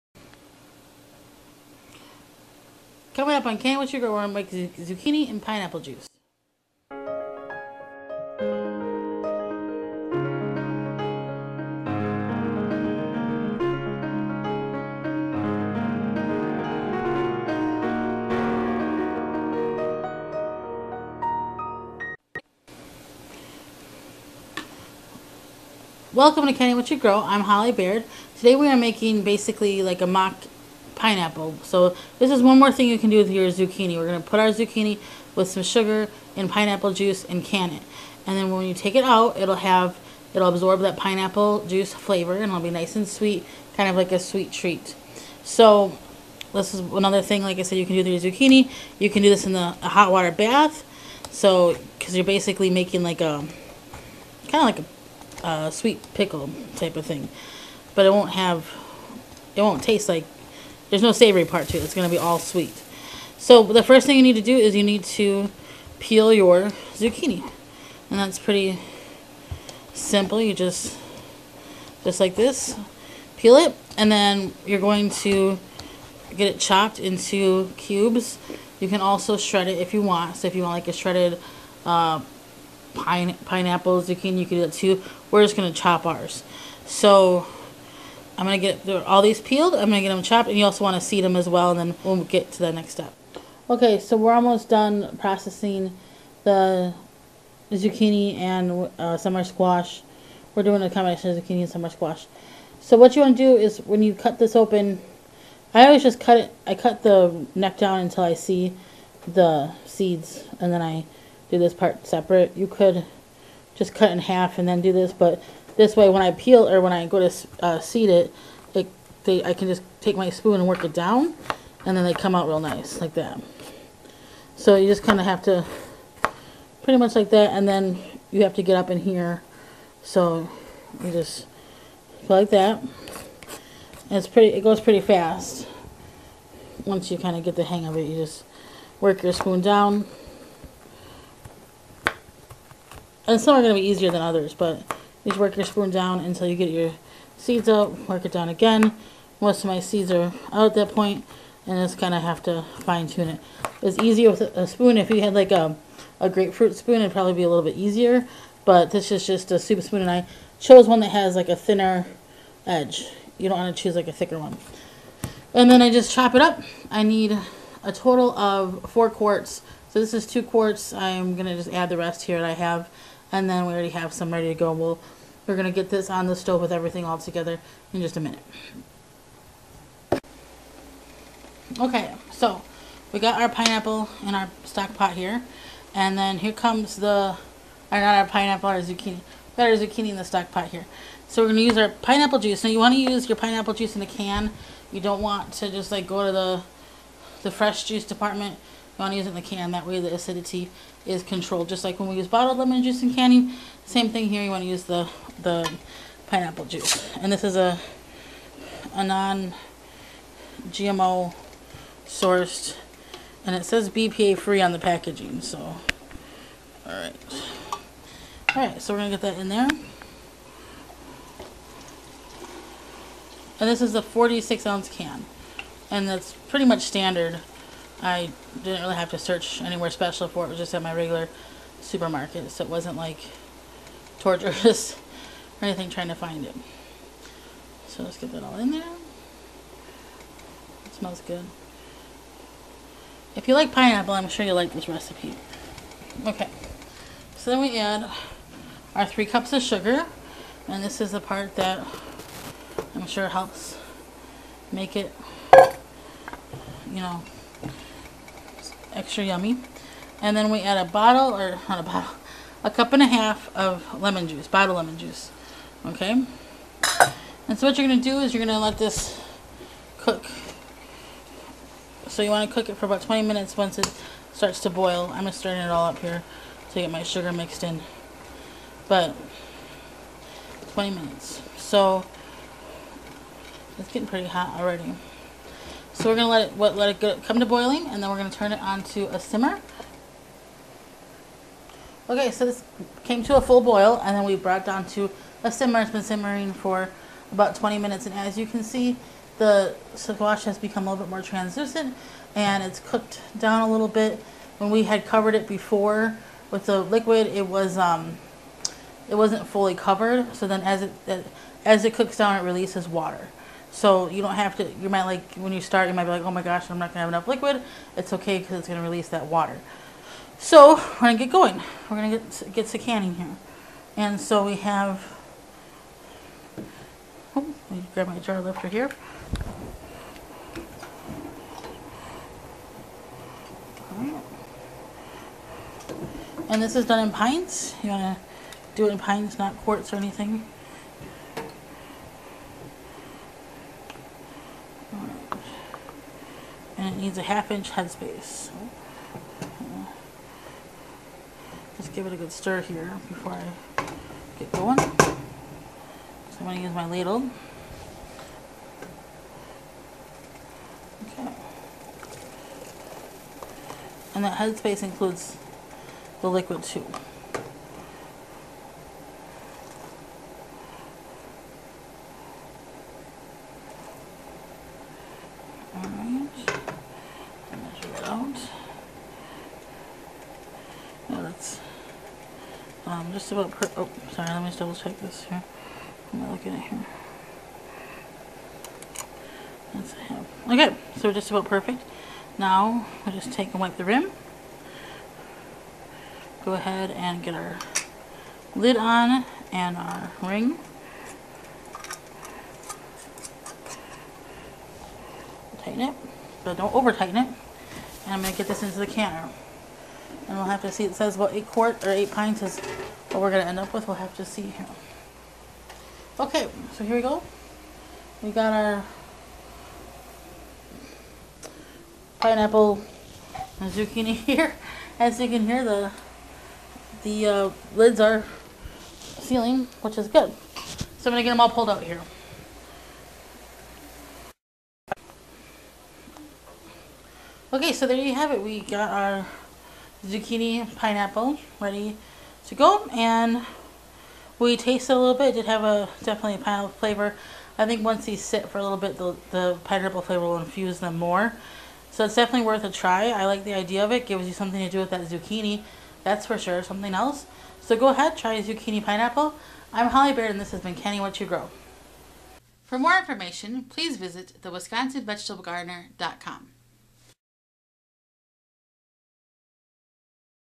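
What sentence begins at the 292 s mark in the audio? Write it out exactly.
Okay, so this came to a full boil and then we brought down to a simmer.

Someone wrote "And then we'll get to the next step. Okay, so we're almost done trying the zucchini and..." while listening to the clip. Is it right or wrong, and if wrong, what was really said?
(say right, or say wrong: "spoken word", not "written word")
wrong: "processing", not "trying".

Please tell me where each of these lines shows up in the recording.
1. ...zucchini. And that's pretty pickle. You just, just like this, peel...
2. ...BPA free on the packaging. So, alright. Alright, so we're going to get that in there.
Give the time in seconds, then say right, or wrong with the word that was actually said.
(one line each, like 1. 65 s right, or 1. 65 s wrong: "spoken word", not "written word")
1. 66 s wrong: "simple", not "pickle"
2. 213 s right.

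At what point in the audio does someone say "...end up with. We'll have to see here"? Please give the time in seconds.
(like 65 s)
413 s.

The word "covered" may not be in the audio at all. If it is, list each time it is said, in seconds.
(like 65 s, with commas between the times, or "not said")
305 s, 309 s.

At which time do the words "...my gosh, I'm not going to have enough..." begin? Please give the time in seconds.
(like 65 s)
316 s.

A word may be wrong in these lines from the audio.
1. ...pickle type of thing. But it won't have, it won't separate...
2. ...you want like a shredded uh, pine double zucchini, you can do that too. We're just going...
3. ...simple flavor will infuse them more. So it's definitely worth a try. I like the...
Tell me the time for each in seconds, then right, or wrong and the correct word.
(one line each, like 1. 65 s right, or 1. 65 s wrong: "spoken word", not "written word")
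1. 56 s wrong: "taste", not "separate"
2. 80 s wrong: "pineapple", not "double"
3. 449 s wrong: "pineapple", not "simple".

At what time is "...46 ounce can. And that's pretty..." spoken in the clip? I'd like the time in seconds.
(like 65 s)
224 s.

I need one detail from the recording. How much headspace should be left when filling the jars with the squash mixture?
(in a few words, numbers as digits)
half inch.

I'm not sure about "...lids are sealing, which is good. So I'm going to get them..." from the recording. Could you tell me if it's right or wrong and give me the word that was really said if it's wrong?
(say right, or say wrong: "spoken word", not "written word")
right.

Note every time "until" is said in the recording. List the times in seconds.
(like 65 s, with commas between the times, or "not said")
107 s, 146 s.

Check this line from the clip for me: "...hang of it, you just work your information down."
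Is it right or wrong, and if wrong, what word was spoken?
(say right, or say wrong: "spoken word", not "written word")
wrong: "spoon", not "information".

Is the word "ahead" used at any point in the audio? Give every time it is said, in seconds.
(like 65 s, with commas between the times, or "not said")
396 s, 457 s.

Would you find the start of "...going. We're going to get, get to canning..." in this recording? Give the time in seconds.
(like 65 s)
321 s.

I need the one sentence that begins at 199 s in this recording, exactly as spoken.
That way the acidity is controlled.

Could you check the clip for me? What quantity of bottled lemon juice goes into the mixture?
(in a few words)
1 and a half cups.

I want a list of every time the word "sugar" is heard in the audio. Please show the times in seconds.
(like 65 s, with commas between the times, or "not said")
3 s, 35 s, 249 s, 277 s.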